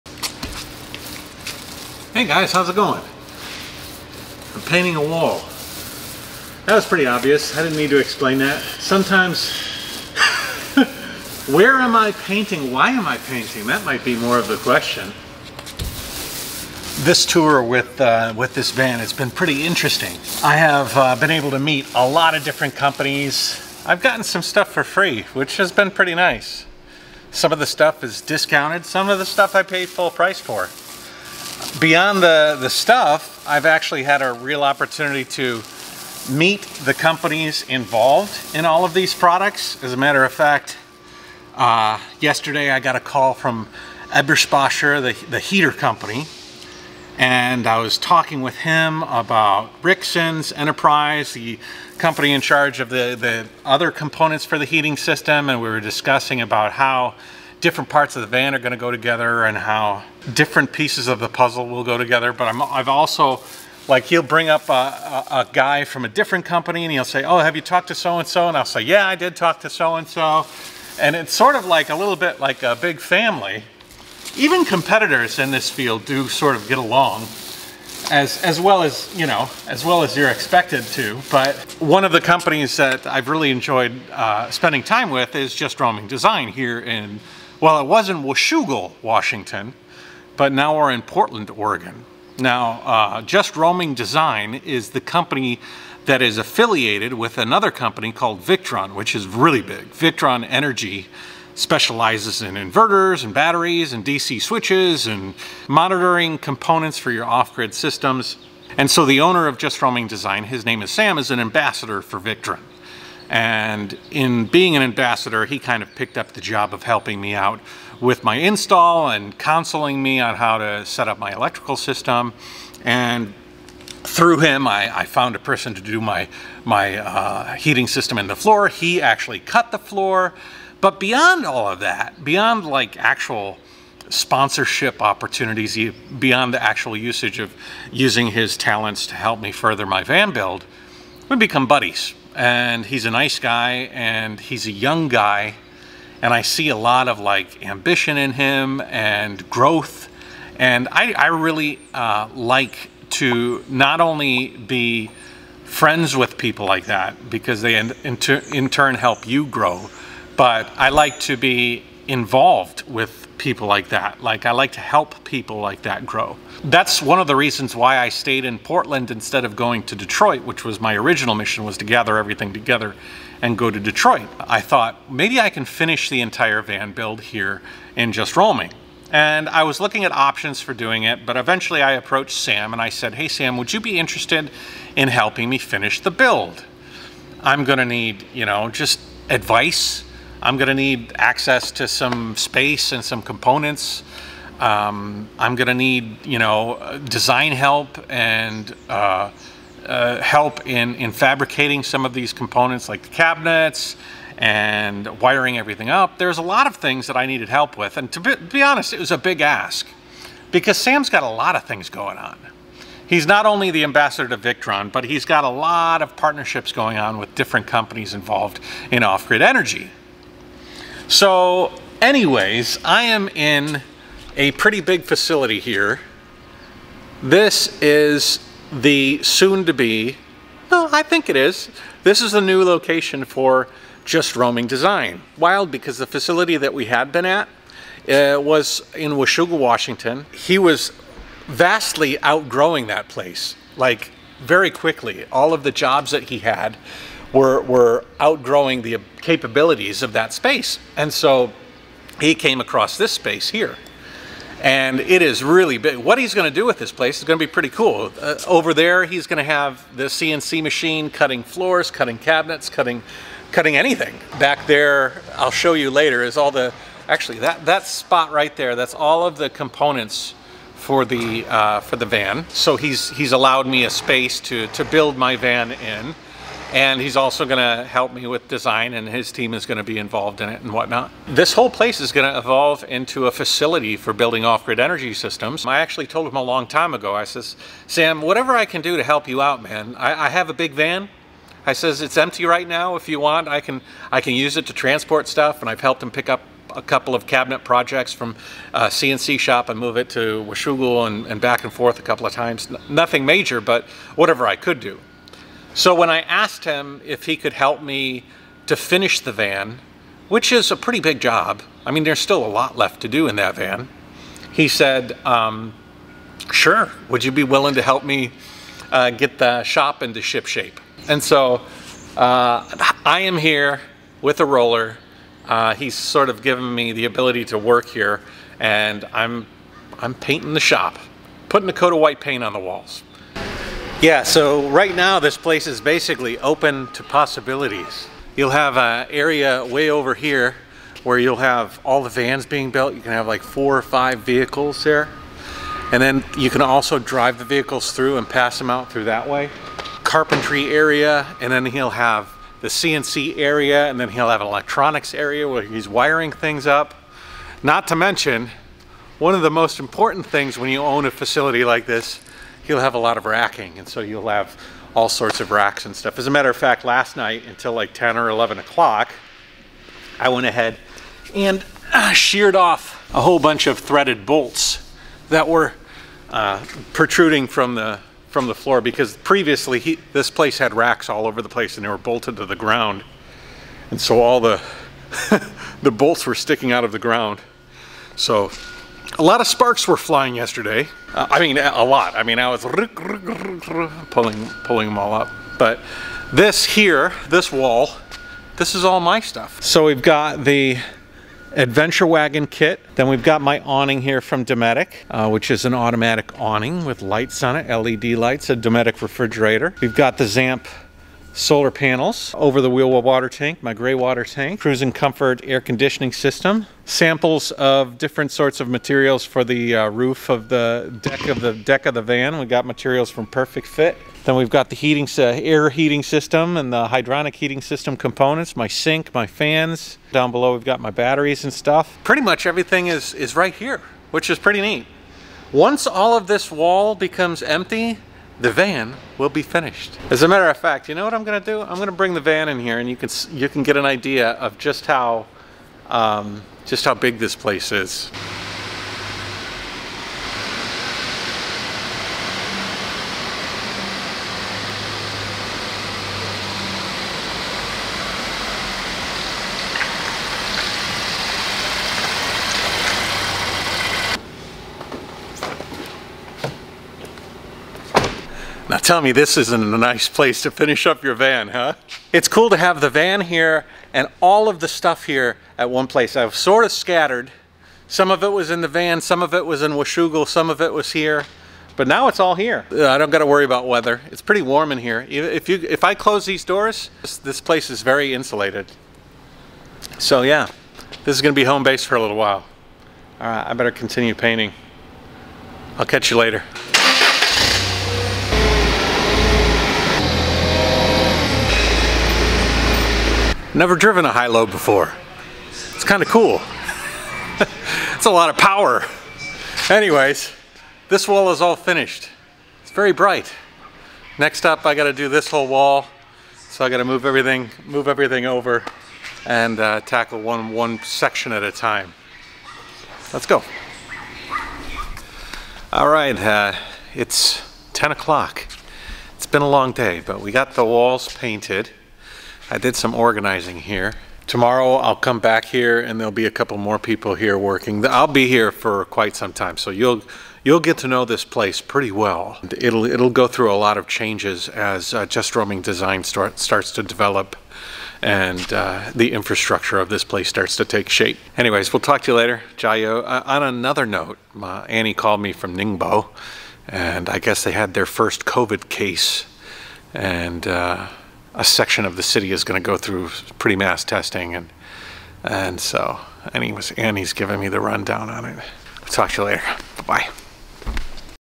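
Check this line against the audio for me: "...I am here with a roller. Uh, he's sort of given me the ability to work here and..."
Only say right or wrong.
right.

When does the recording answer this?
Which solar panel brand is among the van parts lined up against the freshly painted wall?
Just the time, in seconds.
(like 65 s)
410 s.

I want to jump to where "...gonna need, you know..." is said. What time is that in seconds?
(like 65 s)
187 s.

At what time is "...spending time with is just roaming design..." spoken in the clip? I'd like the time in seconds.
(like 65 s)
84 s.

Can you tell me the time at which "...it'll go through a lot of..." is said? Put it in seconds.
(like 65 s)
542 s.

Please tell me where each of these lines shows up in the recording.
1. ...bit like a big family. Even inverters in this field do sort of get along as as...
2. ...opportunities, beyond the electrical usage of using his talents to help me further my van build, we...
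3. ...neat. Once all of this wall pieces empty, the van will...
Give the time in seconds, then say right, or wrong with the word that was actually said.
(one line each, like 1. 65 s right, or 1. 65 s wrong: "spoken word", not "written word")
1. 72 s wrong: "competitors", not "inverters"
2. 135 s wrong: "actual", not "electrical"
3. 434 s wrong: "becomes", not "pieces".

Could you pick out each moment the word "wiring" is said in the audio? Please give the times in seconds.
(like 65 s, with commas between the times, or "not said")
205 s, 355 s.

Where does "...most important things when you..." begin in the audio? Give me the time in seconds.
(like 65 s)
359 s.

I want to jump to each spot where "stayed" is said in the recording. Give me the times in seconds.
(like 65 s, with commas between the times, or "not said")
168 s.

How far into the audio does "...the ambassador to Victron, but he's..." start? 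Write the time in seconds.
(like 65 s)
213 s.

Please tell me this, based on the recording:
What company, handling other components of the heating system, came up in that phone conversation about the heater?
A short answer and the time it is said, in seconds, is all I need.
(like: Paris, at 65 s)
Rixen's Enterprise, at 49 s.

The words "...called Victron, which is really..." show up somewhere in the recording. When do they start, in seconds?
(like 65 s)
98 s.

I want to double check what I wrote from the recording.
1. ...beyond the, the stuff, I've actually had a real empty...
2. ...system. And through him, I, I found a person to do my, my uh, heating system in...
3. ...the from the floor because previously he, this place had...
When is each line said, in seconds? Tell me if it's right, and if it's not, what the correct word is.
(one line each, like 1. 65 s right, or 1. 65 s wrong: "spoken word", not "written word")
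1. 31 s wrong: "opportunity", not "empty"
2. 121 s right
3. 377 s right.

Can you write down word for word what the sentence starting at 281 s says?
This whole place is going to evolve into a facility for building off-grid energy systems.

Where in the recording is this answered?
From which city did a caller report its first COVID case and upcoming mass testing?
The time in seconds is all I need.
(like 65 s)
555 s.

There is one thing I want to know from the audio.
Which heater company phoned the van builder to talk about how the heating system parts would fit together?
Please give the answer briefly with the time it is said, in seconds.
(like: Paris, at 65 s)
Eberspacher, at 44 s.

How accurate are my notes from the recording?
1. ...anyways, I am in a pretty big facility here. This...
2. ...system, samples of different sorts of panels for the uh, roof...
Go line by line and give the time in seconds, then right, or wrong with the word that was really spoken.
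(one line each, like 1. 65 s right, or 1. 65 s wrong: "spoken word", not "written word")
1. 222 s right
2. 416 s wrong: "materials", not "panels".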